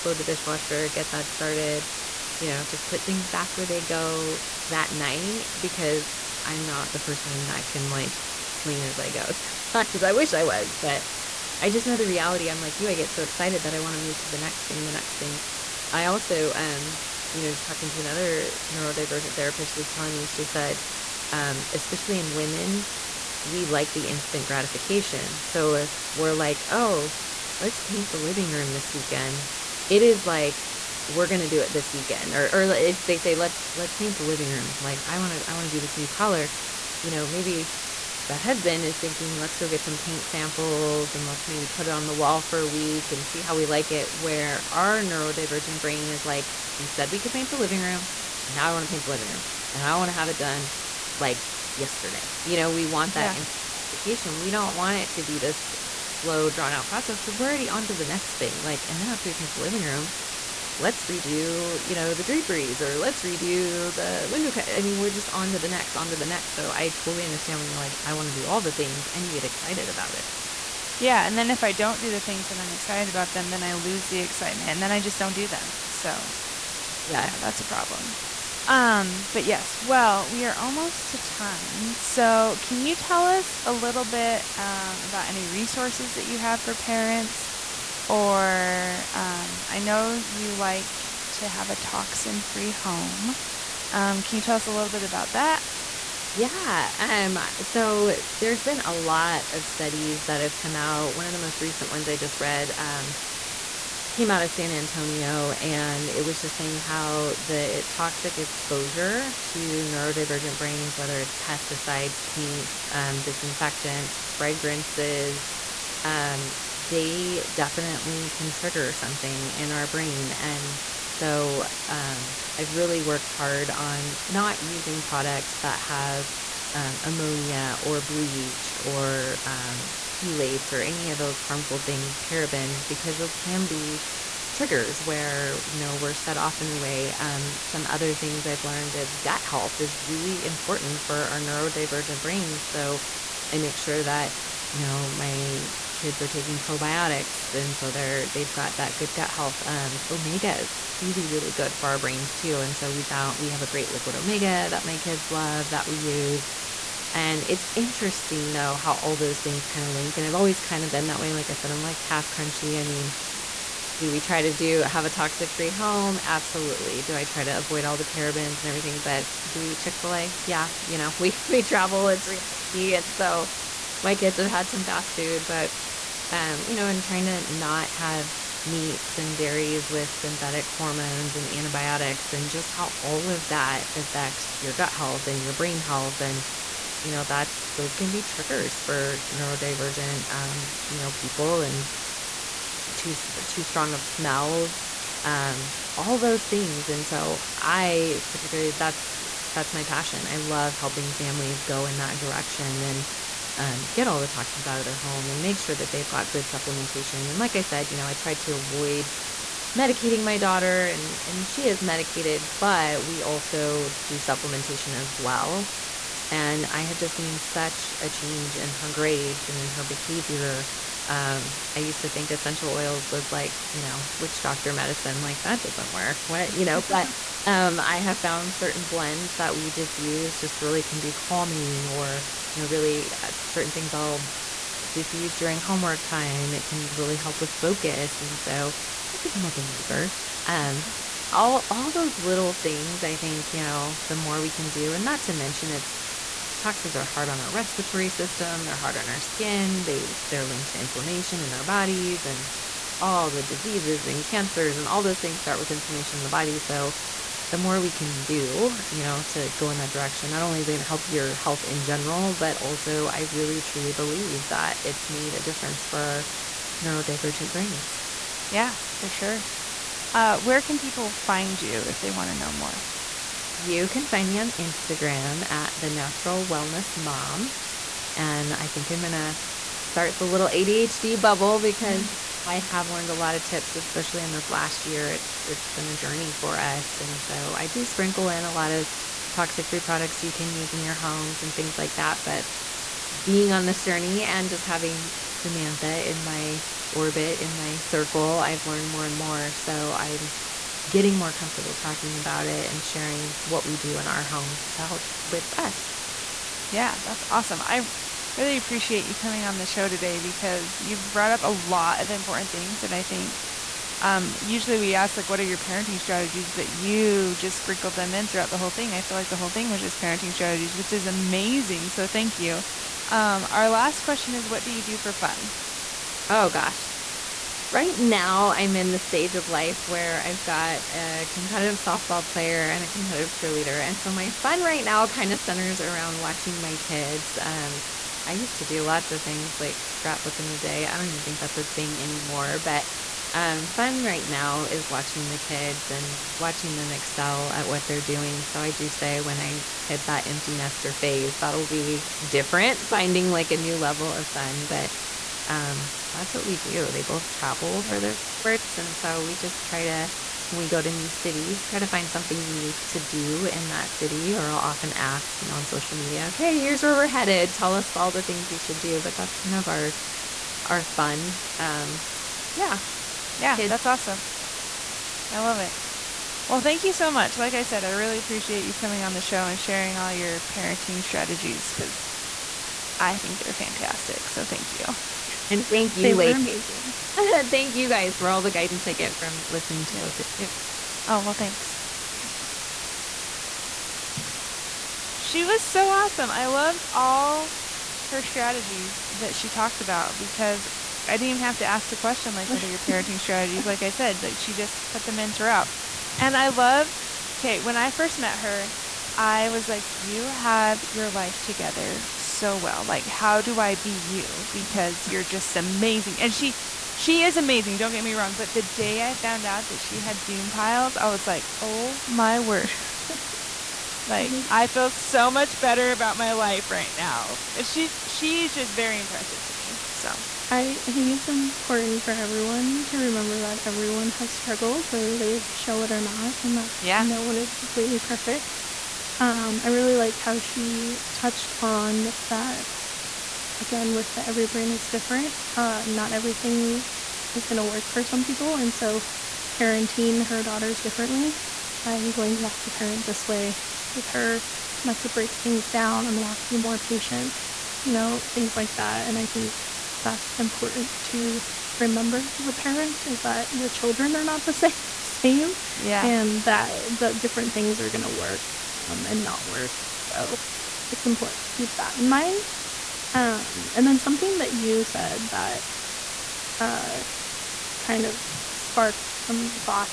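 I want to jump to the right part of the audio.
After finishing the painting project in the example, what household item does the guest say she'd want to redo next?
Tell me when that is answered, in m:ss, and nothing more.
1:02.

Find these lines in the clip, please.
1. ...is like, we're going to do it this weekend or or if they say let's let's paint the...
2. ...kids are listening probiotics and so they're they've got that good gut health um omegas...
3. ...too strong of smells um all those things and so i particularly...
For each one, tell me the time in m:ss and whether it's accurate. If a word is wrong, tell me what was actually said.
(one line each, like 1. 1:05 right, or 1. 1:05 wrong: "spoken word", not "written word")
1. 0:30 right
2. 2:25 wrong: "taking", not "listening"
3. 3:13 right.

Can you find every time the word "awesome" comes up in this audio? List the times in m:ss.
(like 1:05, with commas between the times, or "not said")
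5:07, 6:13, 6:35.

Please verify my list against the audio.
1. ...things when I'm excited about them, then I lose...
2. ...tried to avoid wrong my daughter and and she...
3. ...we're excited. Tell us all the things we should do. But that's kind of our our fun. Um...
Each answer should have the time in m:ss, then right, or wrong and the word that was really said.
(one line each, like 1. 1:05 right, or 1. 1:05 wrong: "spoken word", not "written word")
1. 1:12 right
2. 3:28 wrong: "medicating", not "wrong"
3. 6:06 wrong: "headed", not "excited".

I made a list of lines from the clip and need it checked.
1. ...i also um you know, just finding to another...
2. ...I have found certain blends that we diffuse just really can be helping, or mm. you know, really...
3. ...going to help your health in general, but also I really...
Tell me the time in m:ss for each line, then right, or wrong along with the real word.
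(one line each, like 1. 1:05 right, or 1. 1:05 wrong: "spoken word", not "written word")
1. 0:15 wrong: "talking", not "finding"
2. 3:47 wrong: "calming", not "helping"
3. 4:20 right.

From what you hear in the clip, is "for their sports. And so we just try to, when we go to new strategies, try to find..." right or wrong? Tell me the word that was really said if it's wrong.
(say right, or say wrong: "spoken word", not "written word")
wrong: "cities", not "strategies".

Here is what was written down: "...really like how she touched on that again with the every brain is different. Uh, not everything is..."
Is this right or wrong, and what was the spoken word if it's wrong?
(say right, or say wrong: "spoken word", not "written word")
right.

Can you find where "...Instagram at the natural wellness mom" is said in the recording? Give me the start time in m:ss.
4:34.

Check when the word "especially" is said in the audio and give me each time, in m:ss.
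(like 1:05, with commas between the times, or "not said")
0:21, 4:43.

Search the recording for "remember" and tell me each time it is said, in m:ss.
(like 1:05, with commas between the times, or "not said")
7:12, 7:41.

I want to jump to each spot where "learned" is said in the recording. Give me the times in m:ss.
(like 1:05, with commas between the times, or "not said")
2:18, 4:42, 4:58.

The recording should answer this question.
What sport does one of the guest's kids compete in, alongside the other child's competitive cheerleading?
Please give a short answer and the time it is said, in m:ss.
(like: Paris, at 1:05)
Softball, at 5:31.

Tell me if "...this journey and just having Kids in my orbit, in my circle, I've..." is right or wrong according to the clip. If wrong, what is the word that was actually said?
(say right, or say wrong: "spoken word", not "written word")
wrong: "Samantha", not "Kids".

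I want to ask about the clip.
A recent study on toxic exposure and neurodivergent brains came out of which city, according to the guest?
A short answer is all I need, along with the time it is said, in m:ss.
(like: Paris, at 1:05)
San Antonio, at 1:44.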